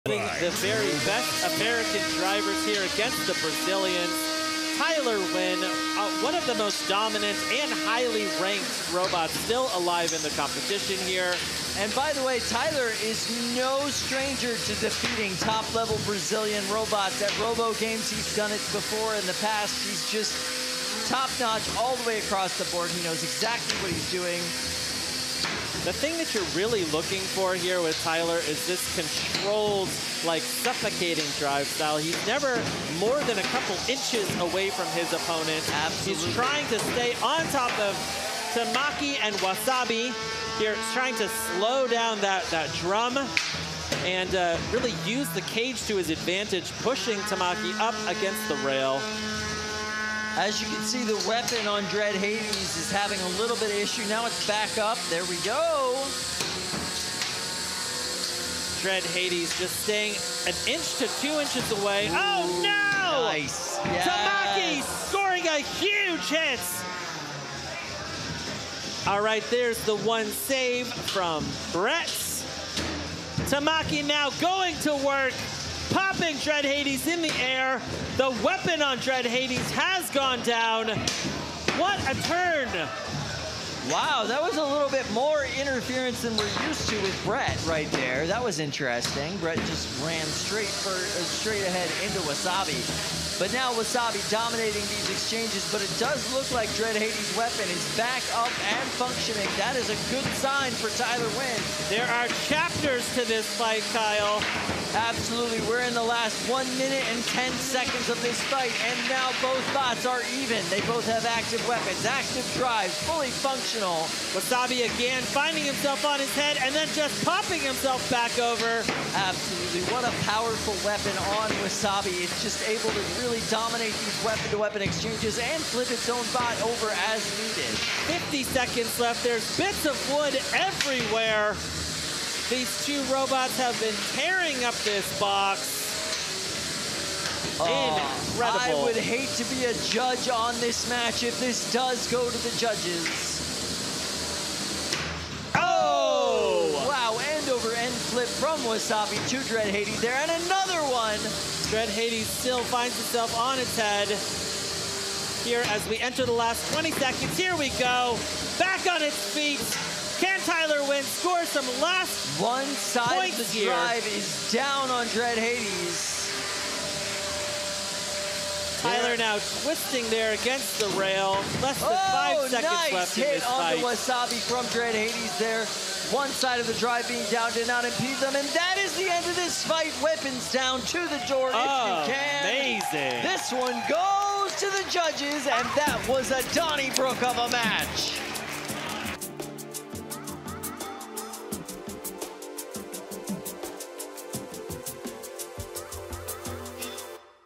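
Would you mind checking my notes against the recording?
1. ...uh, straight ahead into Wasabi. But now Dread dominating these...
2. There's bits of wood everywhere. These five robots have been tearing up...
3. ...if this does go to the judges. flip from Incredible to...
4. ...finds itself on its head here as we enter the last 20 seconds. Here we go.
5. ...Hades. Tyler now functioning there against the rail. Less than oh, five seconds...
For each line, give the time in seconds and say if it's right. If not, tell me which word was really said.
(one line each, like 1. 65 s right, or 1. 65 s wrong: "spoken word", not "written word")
1. 90 s wrong: "Wasabi", not "Dread"
2. 129 s wrong: "two", not "five"
3. 141 s wrong: "Wasabi", not "Incredible"
4. 152 s right
5. 165 s wrong: "twisting", not "functioning".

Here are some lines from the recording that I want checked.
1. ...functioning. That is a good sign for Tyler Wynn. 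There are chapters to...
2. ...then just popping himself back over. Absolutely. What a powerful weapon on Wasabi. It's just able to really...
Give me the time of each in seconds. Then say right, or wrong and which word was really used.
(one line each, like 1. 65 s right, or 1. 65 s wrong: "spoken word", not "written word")
1. 98 s right
2. 116 s right.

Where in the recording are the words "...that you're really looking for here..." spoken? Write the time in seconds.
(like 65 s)
26 s.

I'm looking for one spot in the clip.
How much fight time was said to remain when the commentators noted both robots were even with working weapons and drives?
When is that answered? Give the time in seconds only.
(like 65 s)
106 s.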